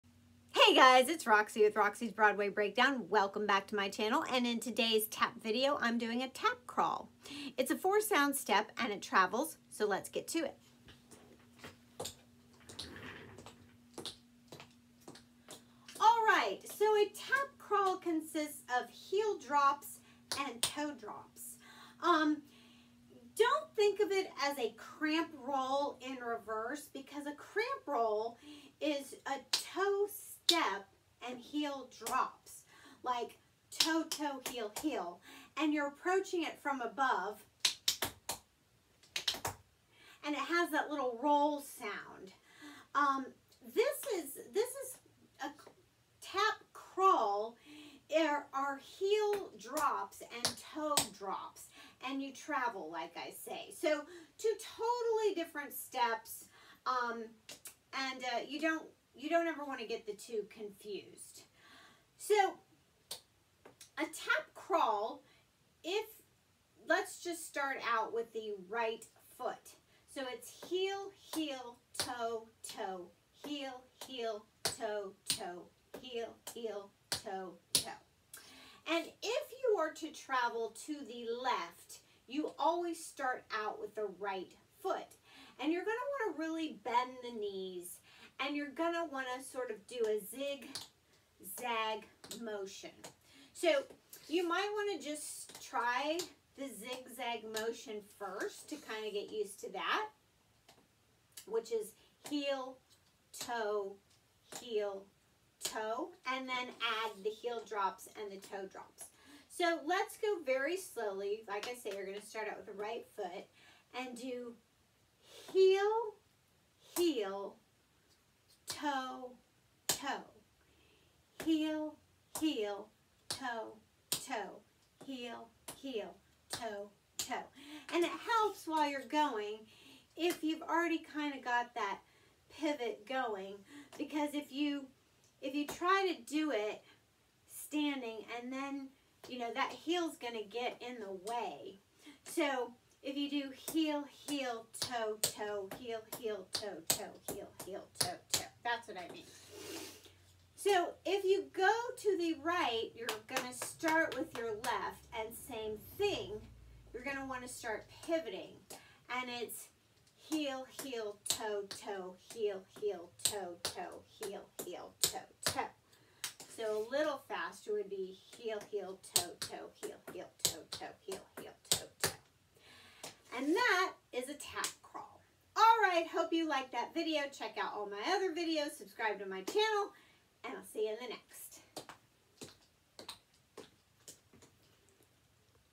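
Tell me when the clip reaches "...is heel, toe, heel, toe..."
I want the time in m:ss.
1:41.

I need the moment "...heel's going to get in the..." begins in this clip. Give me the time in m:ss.
2:19.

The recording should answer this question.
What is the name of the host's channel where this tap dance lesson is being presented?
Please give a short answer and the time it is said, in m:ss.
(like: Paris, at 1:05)
Roxie's Broadway Breakdown, at 0:01.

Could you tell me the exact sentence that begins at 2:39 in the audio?
And it's heel, heel, toe, toe, heel, heel, toe, toe, heel, heel, toe, toe.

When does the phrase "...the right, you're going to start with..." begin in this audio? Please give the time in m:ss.
2:32.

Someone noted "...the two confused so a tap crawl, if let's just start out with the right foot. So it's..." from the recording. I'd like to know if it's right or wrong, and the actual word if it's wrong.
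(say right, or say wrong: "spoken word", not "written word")
right.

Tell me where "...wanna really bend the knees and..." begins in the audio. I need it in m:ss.
1:26.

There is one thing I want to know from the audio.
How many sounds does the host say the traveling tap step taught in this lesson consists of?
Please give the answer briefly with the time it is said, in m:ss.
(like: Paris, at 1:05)
4, at 0:07.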